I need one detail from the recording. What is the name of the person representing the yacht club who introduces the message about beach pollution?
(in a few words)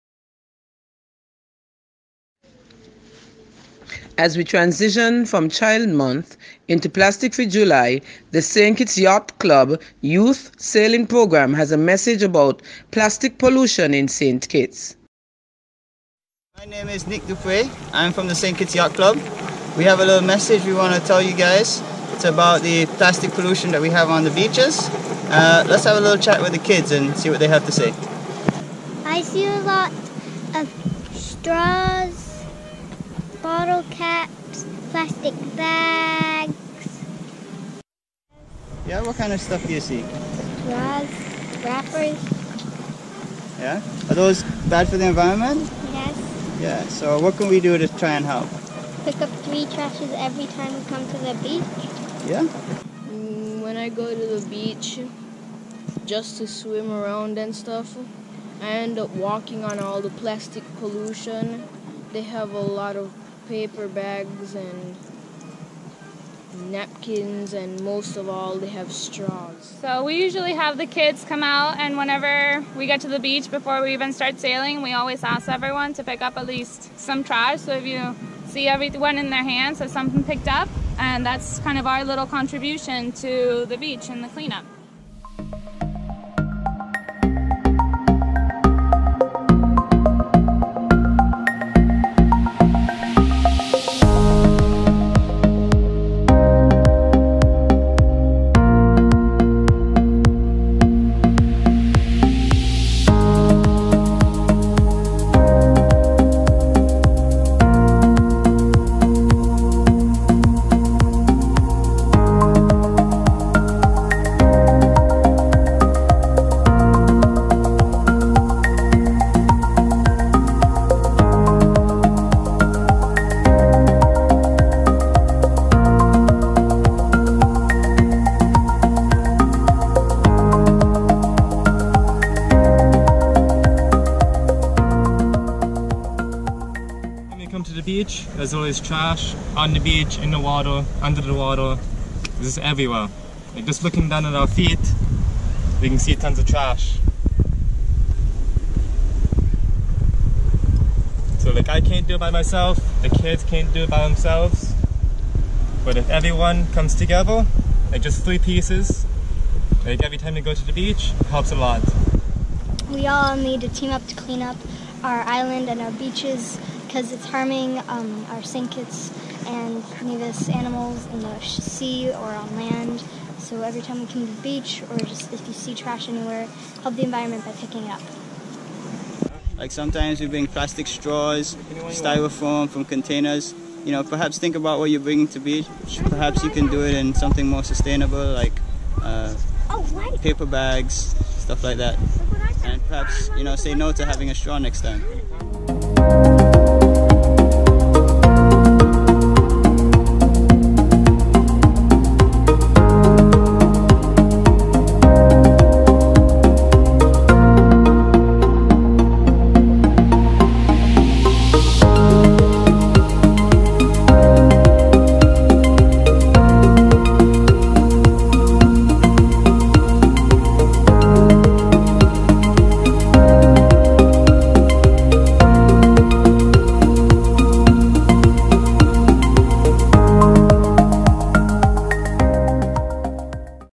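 Nick Dupre.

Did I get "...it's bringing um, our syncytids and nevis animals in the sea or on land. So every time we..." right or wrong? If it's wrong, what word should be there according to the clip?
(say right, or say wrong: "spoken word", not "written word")
wrong: "harming", not "bringing".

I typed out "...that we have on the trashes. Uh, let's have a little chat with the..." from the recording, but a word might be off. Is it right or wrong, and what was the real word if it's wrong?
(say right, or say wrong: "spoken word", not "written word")
wrong: "beaches", not "trashes".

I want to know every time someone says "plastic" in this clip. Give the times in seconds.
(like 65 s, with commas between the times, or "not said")
6 s, 12 s, 23 s, 34 s, 60 s, 180 s.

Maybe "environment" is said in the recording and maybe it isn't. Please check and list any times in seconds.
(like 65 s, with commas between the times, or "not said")
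45 s, 177 s.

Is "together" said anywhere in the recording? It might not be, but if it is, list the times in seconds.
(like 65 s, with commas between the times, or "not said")
156 s.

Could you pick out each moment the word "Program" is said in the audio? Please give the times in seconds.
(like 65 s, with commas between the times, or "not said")
11 s.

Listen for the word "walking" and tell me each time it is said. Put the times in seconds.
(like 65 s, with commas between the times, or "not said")
59 s.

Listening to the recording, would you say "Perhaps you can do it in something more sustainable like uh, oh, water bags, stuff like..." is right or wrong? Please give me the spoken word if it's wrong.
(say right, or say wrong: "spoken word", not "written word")
wrong: "paper", not "water".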